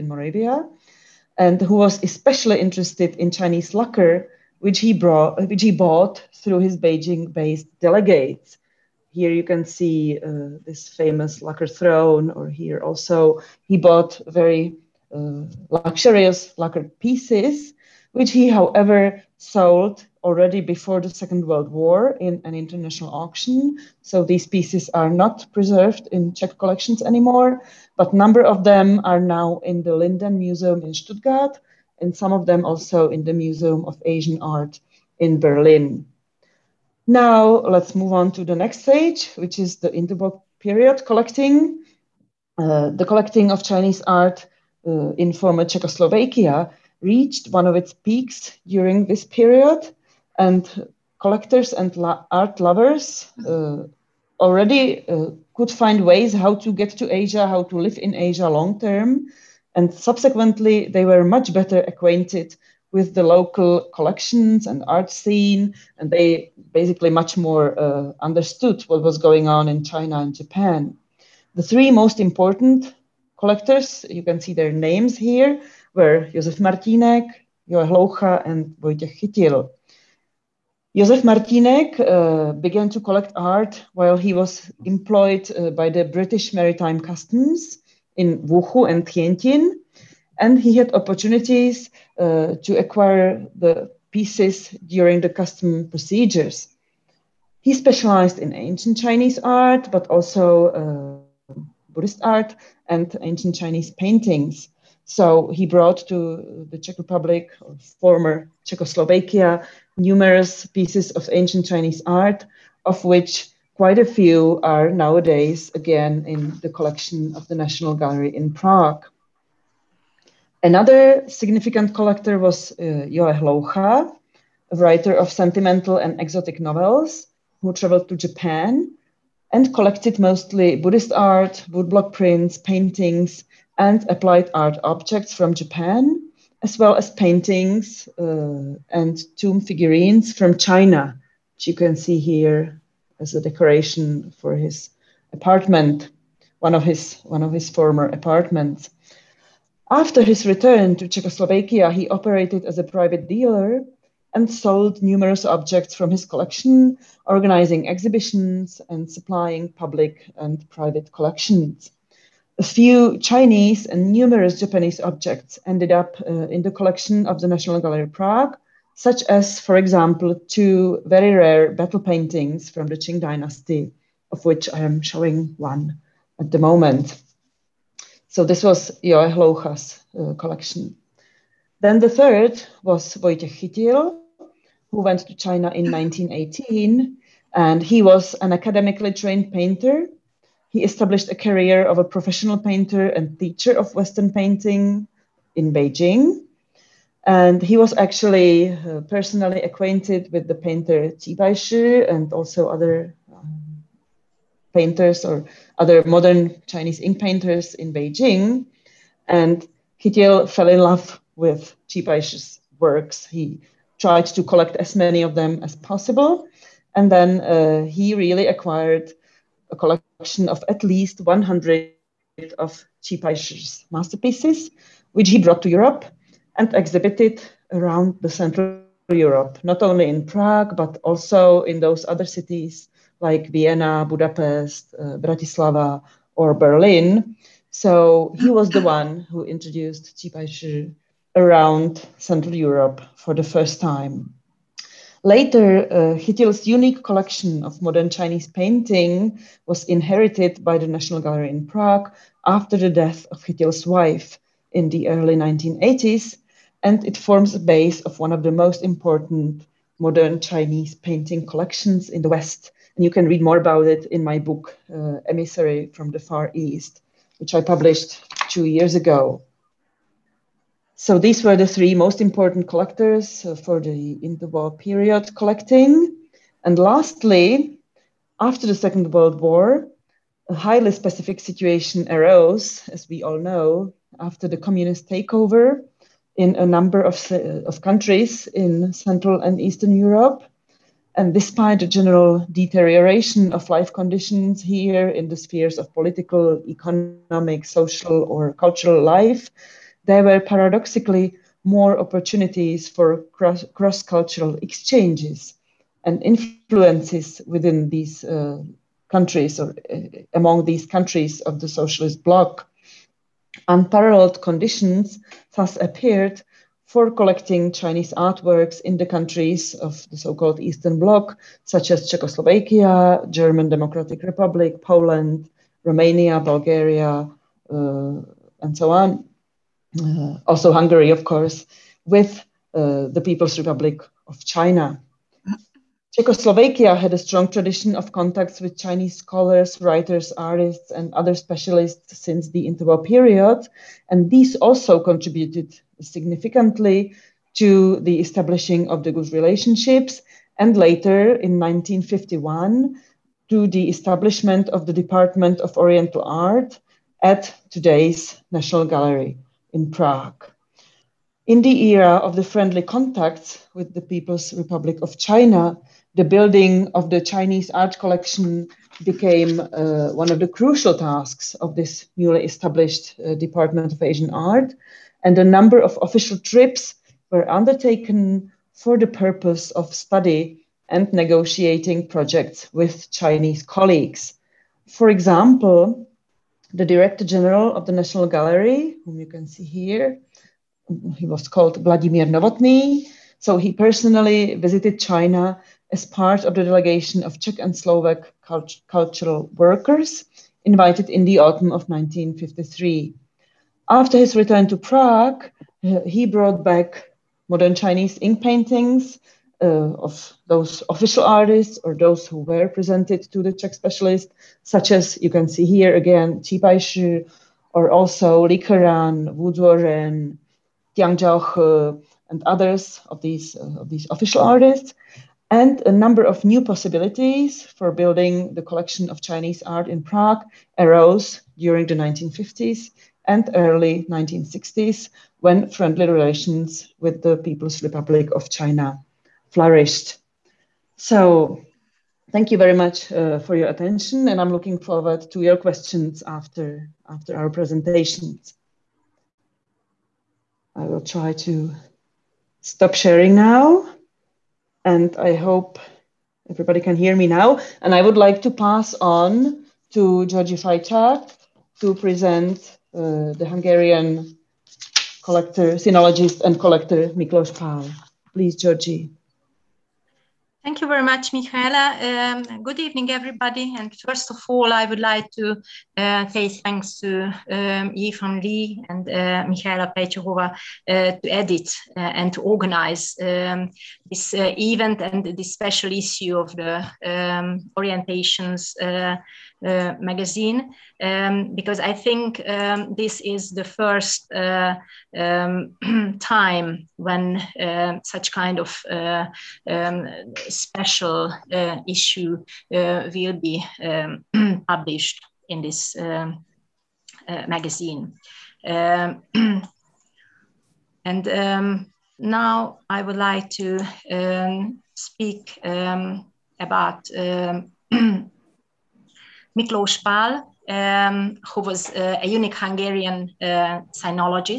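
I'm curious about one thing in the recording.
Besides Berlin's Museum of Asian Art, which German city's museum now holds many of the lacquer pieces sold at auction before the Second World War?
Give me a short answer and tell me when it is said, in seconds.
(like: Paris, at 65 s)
Stuttgart, at 30 s.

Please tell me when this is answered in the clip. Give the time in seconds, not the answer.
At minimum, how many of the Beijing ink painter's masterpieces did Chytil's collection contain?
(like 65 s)
221 s.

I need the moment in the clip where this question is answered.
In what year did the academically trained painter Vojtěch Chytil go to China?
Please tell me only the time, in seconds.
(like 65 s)
185 s.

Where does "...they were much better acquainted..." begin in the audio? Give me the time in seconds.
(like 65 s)
60 s.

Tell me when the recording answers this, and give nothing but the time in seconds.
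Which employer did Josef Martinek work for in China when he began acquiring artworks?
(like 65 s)
86 s.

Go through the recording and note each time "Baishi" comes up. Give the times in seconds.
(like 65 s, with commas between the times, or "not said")
201 s, 212 s, 416 s.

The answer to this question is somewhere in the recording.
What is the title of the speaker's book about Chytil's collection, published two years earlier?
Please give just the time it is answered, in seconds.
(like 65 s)
265 s.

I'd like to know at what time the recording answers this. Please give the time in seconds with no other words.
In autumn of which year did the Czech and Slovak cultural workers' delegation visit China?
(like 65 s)
401 s.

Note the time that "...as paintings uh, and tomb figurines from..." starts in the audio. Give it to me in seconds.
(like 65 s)
136 s.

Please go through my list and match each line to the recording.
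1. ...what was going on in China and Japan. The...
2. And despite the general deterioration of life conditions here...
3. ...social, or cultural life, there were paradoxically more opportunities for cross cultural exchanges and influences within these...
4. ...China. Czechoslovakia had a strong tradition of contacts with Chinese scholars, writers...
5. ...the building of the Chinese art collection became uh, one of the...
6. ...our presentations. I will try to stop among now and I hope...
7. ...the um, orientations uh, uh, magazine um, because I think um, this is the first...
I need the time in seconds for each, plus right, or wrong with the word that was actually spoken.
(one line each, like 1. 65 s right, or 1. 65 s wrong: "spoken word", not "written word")
1. 68 s right
2. 291 s right
3. 297 s right
4. 334 s right
5. 366 s right
6. 447 s wrong: "sharing", not "among"
7. 486 s right.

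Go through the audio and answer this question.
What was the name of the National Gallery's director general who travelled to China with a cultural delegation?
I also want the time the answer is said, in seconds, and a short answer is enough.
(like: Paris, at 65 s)
Vladimir Novotny, at 391 s.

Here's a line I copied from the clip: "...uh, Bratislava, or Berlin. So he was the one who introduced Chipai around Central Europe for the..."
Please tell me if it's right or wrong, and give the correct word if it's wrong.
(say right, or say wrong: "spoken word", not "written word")
right.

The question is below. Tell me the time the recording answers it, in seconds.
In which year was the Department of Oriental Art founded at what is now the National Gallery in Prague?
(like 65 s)
351 s.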